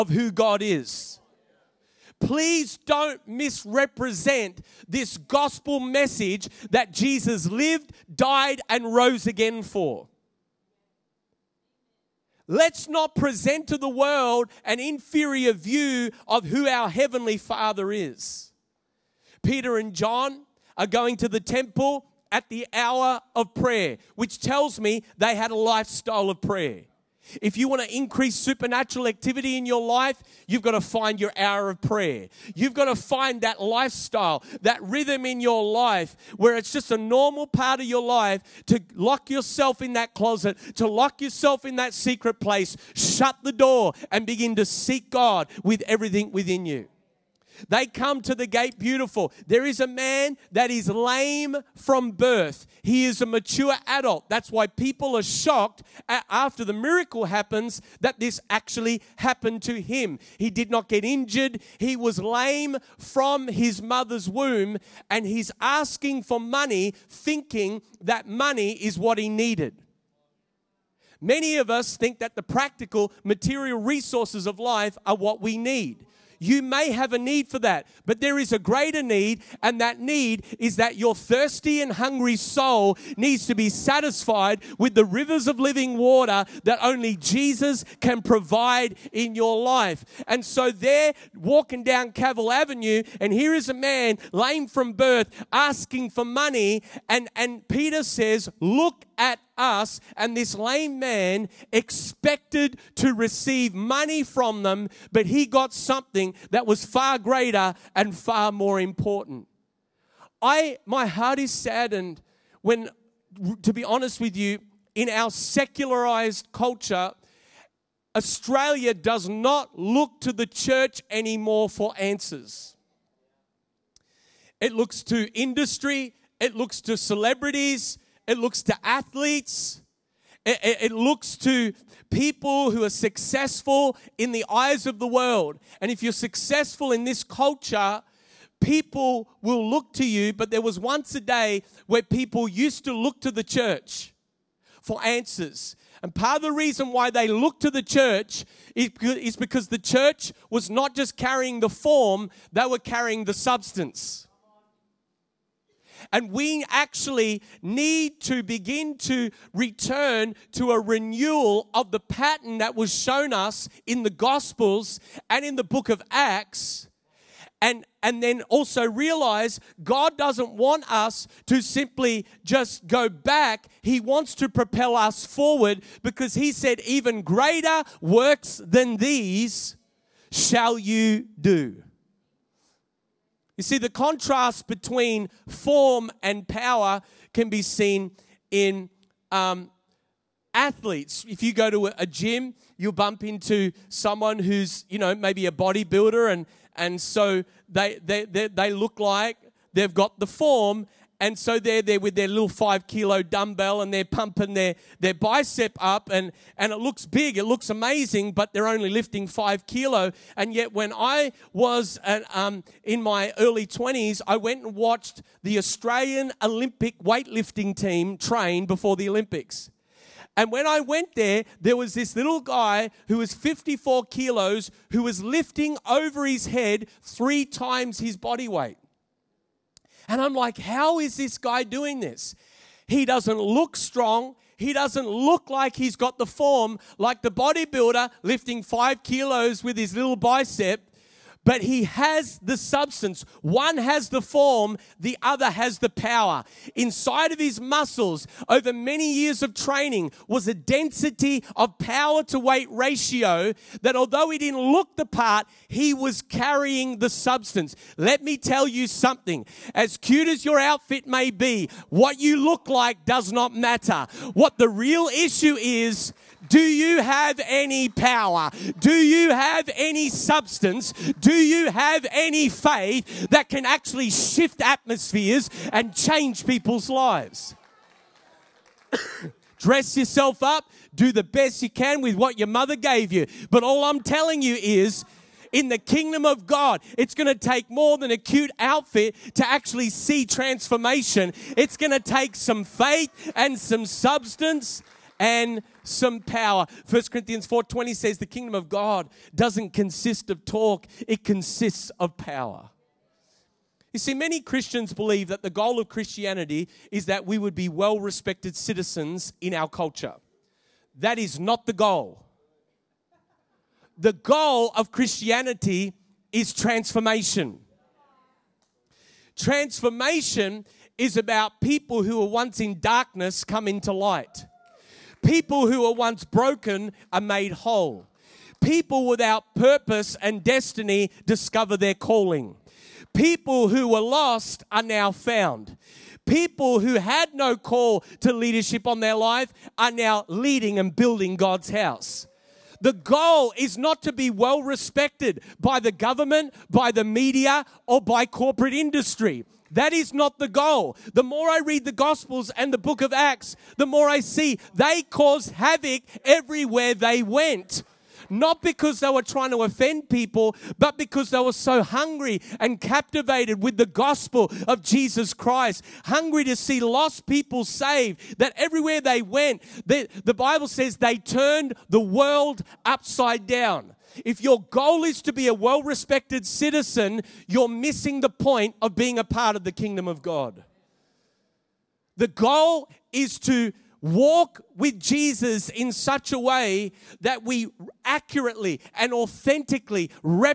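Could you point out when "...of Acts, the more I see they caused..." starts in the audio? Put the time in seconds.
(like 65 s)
353 s.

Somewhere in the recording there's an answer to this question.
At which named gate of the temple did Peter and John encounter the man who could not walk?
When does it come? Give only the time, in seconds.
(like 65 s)
48 s.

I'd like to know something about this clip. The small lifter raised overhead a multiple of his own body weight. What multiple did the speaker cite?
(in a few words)
3 times.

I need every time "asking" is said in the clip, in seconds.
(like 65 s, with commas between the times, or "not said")
65 s, 95 s.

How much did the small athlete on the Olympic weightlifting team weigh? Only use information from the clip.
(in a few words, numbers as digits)
54 kilos.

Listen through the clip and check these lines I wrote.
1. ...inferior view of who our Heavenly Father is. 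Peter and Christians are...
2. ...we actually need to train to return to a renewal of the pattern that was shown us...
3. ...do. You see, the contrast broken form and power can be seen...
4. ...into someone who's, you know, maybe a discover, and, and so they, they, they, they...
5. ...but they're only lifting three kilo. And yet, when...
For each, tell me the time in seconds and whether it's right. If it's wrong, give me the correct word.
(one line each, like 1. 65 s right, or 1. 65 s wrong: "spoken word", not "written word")
1. 14 s wrong: "John", not "Christians"
2. 156 s wrong: "begin", not "train"
3. 181 s wrong: "between", not "broken"
4. 193 s wrong: "bodybuilder", not "discover"
5. 208 s wrong: "five", not "three".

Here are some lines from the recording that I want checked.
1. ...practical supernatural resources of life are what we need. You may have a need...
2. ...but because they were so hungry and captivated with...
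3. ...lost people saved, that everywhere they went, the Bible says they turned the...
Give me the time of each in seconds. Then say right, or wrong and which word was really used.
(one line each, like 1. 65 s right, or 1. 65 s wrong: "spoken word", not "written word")
1. 72 s wrong: "material", not "supernatural"
2. 360 s right
3. 366 s right.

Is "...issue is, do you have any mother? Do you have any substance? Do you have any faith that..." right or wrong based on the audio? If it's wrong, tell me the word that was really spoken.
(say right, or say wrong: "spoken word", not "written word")
wrong: "power", not "mother".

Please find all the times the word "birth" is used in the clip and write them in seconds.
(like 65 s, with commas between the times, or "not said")
52 s, 94 s.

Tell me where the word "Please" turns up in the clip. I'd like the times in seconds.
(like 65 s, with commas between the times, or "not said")
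2 s.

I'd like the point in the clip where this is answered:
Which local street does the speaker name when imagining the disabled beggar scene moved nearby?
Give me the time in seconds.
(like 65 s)
92 s.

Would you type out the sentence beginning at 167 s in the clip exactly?
And, and then also realize God doesn't want us to simply just go back.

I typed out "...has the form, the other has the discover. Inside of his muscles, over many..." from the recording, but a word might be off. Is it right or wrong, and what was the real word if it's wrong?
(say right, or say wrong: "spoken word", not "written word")
wrong: "power", not "discover".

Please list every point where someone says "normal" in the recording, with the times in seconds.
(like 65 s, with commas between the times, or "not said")
36 s.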